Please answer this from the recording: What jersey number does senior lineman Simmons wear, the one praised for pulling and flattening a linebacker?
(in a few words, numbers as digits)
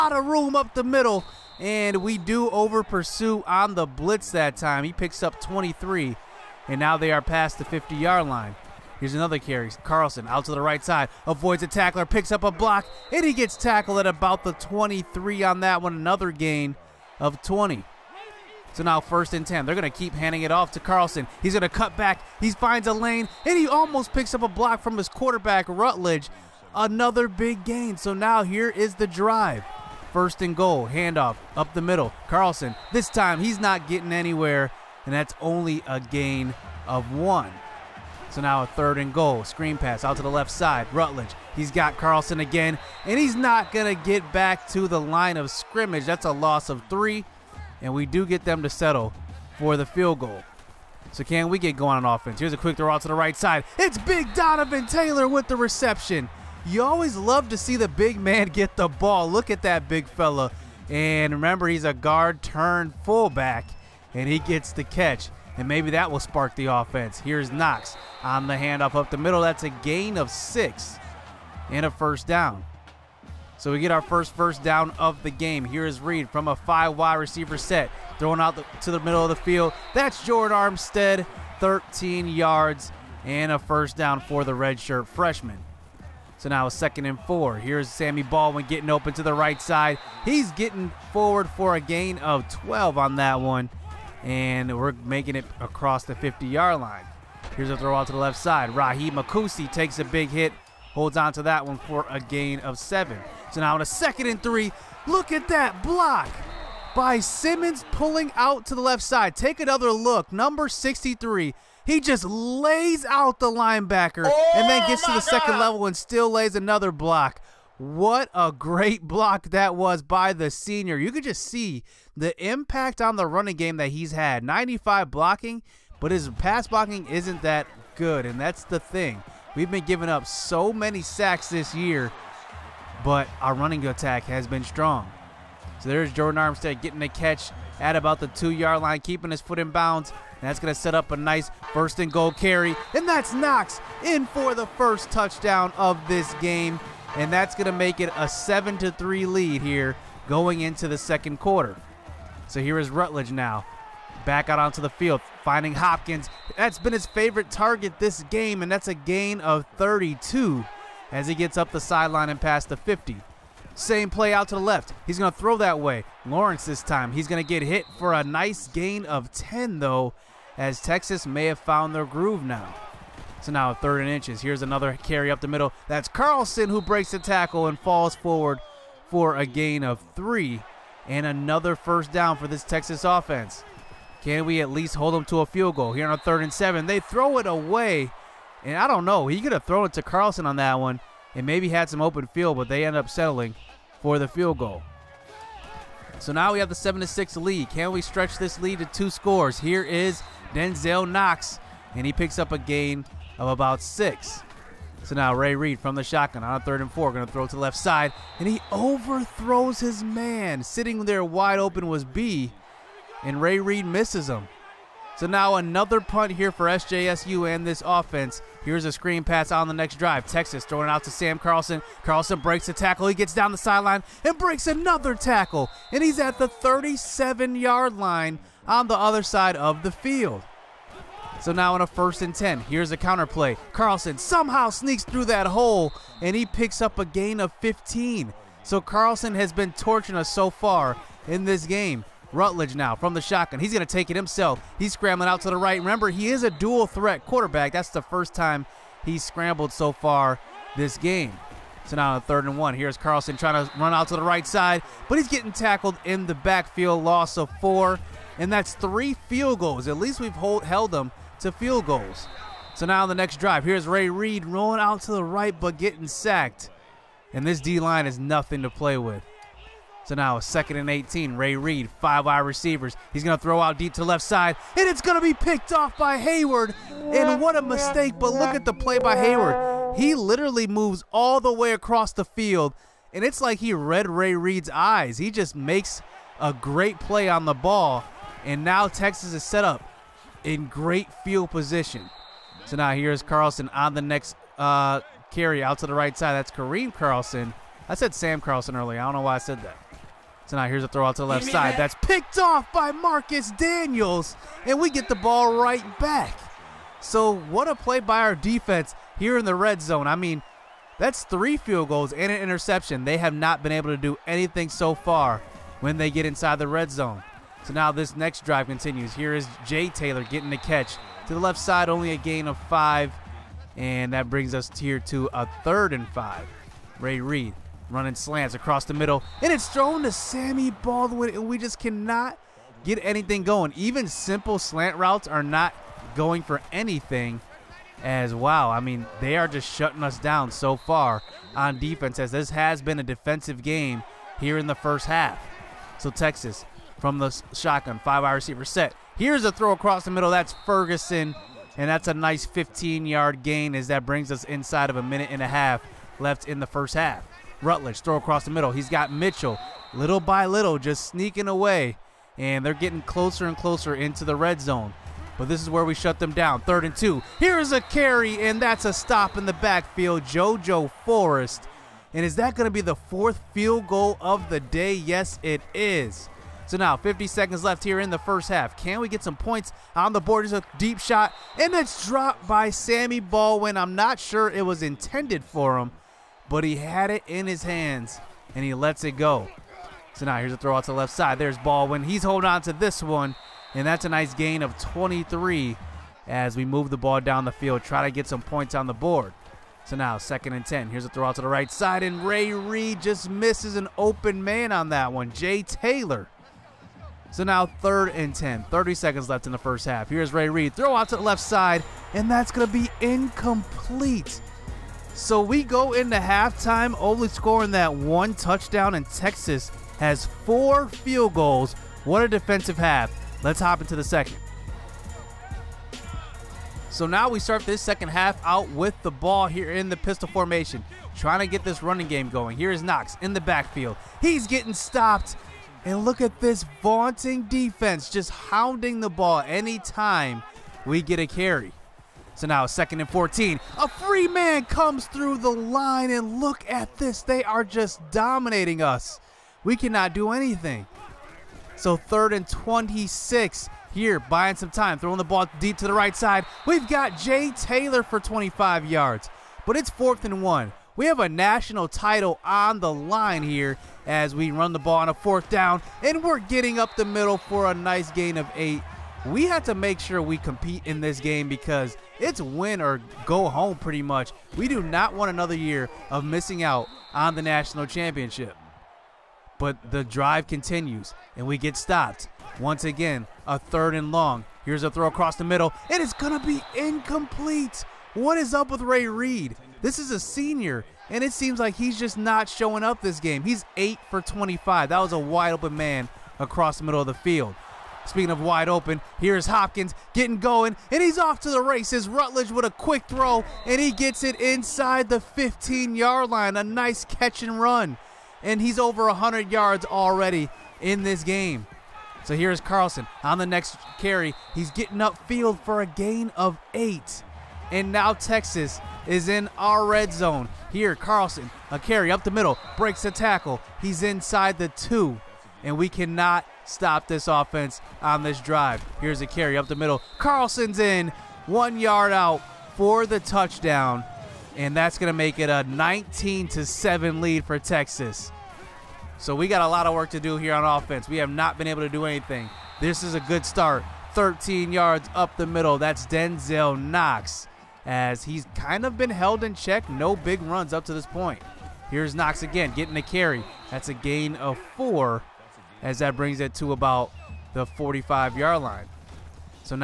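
63.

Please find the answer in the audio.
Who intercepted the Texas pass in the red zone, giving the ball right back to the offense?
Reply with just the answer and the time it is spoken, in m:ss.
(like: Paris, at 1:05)
Marcus Daniels, at 5:02.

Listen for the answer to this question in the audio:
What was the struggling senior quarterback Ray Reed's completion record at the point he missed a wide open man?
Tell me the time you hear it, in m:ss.
8:13.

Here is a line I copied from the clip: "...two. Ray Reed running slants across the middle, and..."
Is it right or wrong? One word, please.
wrong.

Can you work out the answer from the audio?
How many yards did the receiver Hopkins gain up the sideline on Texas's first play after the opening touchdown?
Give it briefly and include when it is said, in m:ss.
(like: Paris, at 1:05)
32, at 2:38.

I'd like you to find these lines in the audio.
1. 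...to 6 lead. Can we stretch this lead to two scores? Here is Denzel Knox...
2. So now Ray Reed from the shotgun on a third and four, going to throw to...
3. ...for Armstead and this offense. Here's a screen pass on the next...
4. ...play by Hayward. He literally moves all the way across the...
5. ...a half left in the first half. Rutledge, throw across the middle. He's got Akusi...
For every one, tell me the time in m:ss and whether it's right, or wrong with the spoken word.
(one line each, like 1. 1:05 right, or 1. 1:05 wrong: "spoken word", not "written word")
1. 3:17 right
2. 3:25 right
3. 3:36 wrong: "SJSU", not "Armstead"
4. 4:38 right
5. 5:55 wrong: "Mitchell", not "Akusi".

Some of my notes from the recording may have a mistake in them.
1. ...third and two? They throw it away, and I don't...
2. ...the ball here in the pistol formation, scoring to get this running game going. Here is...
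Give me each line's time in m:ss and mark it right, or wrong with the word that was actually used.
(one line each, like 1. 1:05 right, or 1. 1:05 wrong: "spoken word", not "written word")
1. 3:06 wrong: "seven", not "two"
2. 7:09 wrong: "trying", not "scoring".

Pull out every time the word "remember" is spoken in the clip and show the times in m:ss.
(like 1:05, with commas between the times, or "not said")
1:01, 4:05.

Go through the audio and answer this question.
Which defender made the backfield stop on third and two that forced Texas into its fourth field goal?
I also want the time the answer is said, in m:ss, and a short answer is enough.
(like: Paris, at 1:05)
JoJo Forest, at 6:10.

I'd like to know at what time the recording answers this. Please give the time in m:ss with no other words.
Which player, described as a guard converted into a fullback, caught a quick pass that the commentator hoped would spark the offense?
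0:53.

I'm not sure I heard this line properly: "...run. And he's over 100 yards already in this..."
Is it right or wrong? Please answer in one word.
right.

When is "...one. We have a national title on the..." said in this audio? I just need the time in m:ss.
7:40.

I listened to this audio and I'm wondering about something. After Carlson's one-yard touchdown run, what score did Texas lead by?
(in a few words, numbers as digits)
19 to 7.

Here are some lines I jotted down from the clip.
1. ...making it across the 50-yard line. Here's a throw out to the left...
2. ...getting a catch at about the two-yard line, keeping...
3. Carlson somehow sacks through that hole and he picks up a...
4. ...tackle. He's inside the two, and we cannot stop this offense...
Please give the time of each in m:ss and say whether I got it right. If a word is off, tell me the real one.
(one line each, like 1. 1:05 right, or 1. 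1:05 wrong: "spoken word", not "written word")
1. 1:35 right
2. 2:16 right
3. 3:53 wrong: "sneaks", not "sacks"
4. 8:43 right.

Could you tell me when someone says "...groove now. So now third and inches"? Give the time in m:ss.
2:52.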